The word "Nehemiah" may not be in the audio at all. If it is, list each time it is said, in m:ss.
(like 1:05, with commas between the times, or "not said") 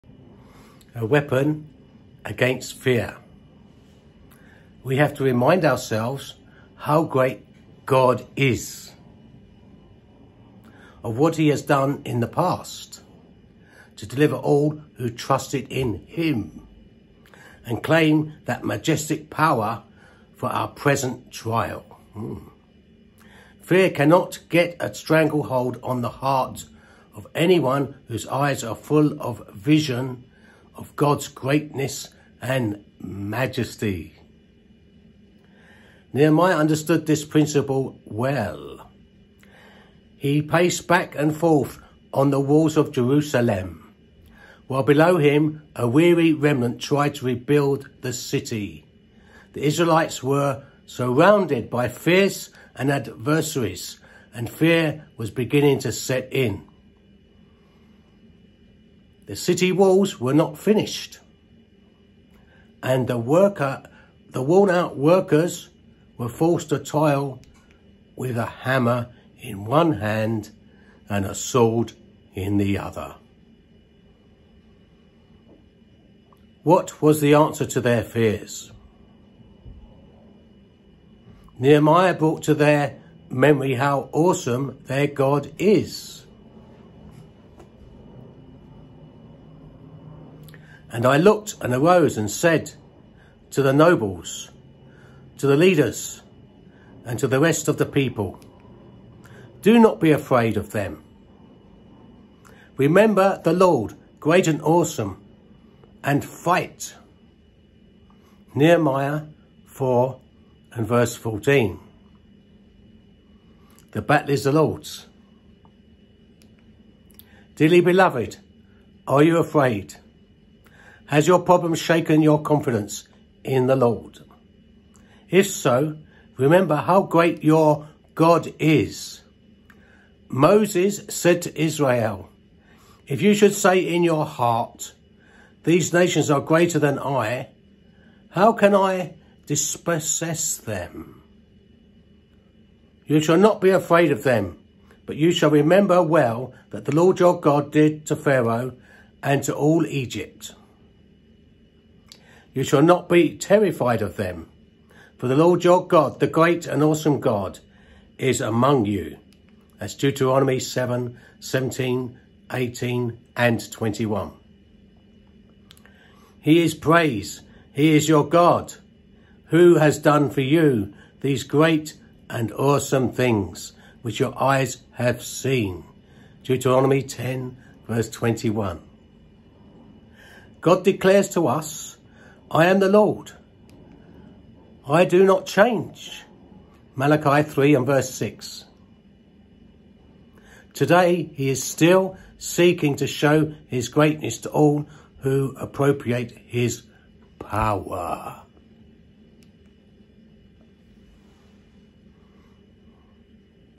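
0:36, 1:21, 1:48.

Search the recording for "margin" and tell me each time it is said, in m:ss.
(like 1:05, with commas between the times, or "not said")
not said.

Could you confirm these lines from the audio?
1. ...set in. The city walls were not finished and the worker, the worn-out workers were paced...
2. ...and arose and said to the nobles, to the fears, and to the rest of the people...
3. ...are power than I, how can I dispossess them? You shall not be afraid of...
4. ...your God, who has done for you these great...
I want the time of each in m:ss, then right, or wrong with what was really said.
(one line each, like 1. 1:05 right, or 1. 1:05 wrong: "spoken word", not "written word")
1. 0:55 wrong: "forced", not "paced"
2. 1:31 wrong: "leaders", not "fears"
3. 2:16 wrong: "greater", not "power"
4. 2:48 right.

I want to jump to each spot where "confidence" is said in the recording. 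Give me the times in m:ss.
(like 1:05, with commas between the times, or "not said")
2:02.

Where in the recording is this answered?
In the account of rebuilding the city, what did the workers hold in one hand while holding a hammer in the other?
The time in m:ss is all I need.
1:11.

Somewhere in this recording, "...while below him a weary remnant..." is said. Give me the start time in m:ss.
0:44.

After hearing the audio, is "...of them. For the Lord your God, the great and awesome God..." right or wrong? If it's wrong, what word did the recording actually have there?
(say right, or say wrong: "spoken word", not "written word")
right.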